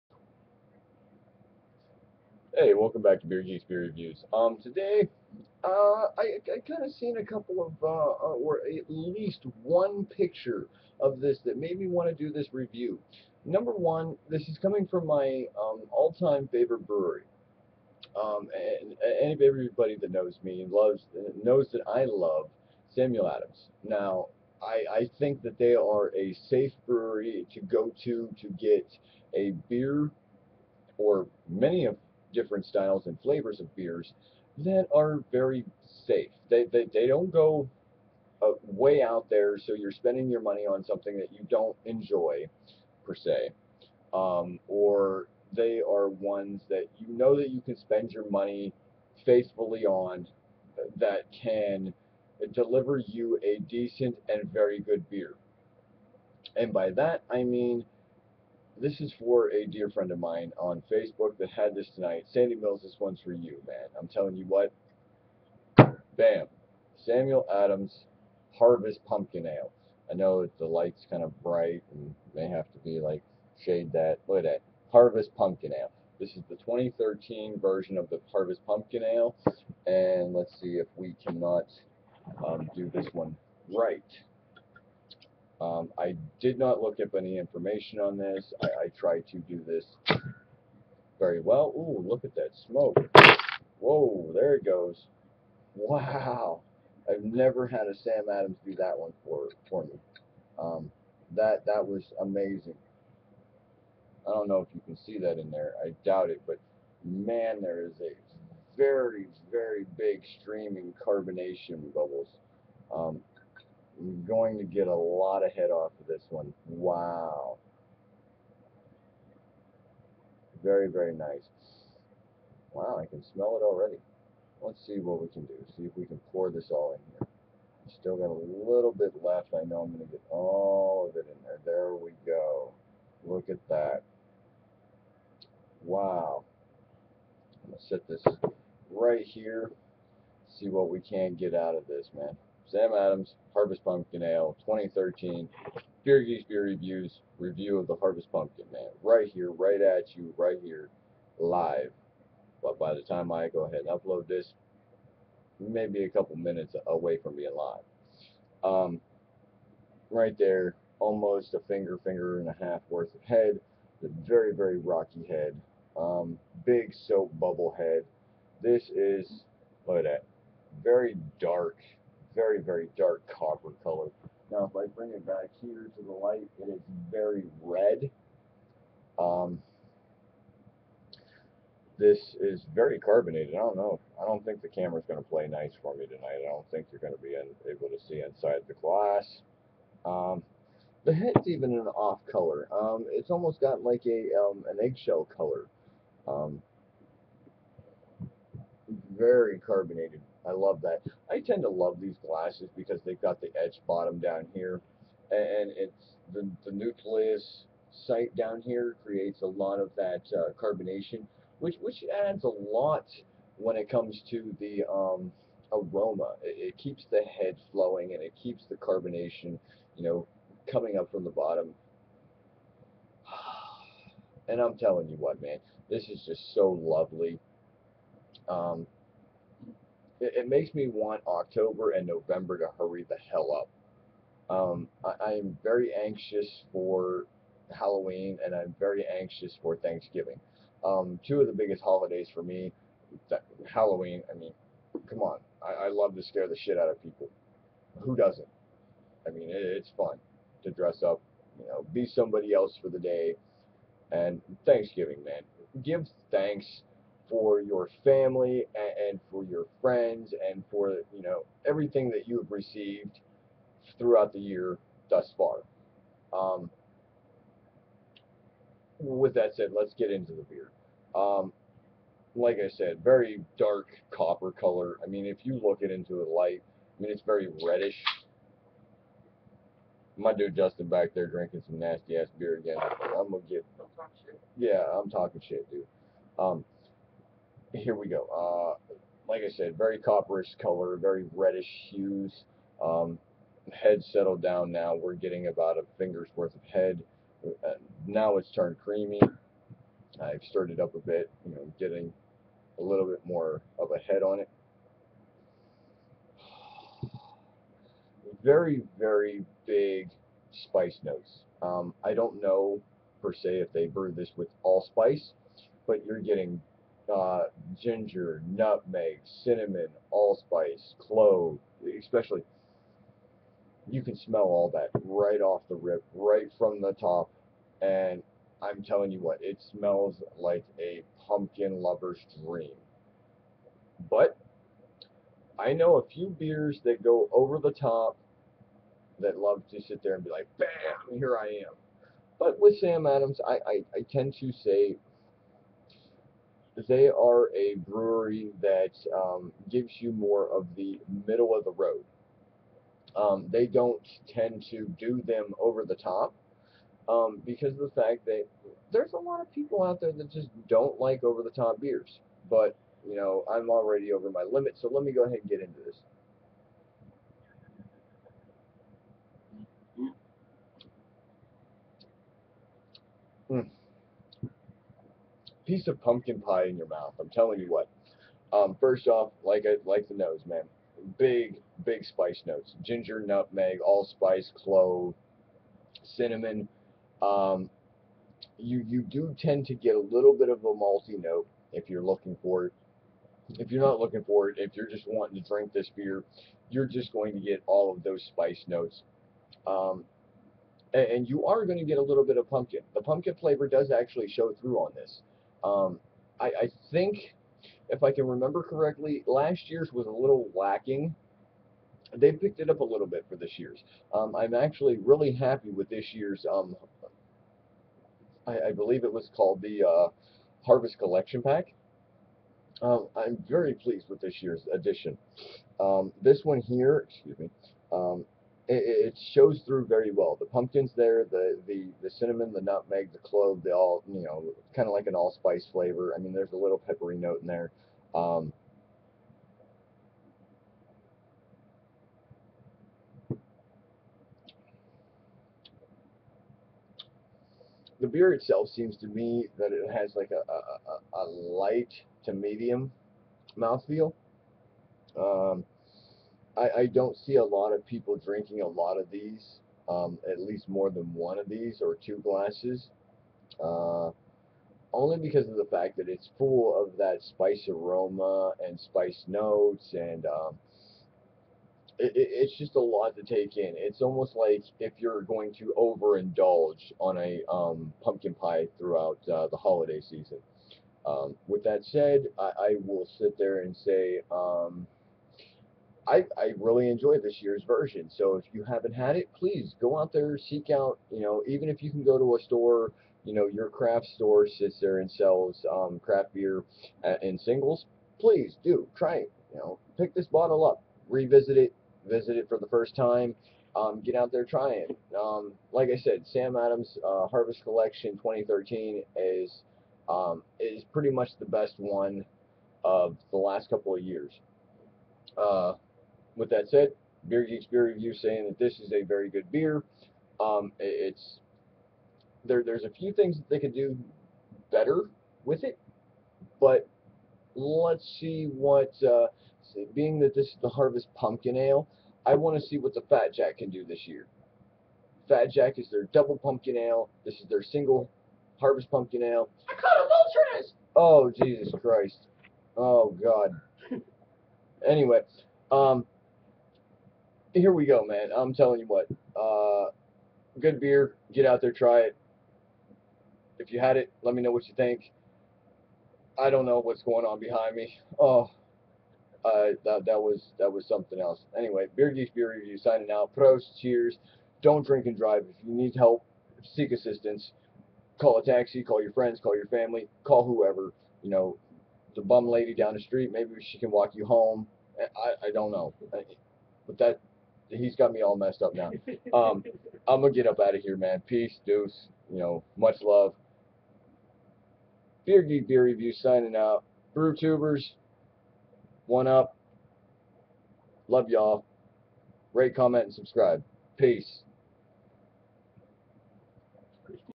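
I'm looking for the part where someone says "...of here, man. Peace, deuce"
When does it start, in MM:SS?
09:40.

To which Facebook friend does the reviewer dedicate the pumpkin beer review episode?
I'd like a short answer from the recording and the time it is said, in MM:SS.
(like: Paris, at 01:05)
Sandy Mills, at 01:02.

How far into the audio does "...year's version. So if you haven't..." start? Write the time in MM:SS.
08:07.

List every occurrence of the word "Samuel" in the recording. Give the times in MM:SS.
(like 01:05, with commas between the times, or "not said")
00:22, 01:07.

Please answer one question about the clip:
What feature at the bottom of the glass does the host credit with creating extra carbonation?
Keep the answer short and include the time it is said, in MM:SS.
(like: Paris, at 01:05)
Nucleus site, at 03:26.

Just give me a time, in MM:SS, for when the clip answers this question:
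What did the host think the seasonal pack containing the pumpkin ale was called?
07:00.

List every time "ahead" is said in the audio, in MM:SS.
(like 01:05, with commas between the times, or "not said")
02:33, 06:05.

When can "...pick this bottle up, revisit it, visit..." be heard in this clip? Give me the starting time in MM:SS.
08:19.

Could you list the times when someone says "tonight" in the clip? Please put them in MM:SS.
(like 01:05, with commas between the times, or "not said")
01:01, 03:06.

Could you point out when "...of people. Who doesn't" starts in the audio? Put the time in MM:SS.
04:06.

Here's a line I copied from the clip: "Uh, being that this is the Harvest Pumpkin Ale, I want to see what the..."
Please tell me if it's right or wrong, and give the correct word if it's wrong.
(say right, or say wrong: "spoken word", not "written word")
right.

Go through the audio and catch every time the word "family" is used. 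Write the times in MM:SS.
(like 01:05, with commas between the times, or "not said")
04:18, 09:29.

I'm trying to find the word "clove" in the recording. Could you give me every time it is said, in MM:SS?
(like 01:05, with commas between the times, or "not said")
05:20, 06:24, 07:13.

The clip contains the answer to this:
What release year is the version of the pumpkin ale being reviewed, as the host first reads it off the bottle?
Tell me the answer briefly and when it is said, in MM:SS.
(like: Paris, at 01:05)
2013, at 01:16.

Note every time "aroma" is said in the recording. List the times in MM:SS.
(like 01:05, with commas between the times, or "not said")
03:35, 07:47.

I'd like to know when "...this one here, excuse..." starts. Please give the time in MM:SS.
07:06.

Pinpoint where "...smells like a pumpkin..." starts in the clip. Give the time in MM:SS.
05:29.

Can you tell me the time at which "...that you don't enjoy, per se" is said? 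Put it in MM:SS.
00:41.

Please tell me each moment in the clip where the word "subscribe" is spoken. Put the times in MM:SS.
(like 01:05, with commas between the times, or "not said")
09:53.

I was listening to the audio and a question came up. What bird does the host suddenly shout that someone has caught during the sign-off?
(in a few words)
Vulture.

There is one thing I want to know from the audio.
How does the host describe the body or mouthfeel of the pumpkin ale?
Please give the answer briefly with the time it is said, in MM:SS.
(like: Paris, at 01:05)
Light to medium, at 07:31.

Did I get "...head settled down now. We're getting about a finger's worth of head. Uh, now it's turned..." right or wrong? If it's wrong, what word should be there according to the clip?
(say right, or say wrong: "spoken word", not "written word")
right.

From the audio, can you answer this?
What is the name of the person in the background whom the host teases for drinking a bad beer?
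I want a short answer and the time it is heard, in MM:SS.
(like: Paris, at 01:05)
Justin, at 04:40.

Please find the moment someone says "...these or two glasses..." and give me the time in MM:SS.
07:41.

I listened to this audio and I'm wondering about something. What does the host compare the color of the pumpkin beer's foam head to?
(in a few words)
Eggshell.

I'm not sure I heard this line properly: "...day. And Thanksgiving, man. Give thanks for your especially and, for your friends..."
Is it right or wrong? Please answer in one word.
wrong.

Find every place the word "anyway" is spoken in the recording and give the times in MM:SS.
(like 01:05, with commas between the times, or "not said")
09:04, 09:21.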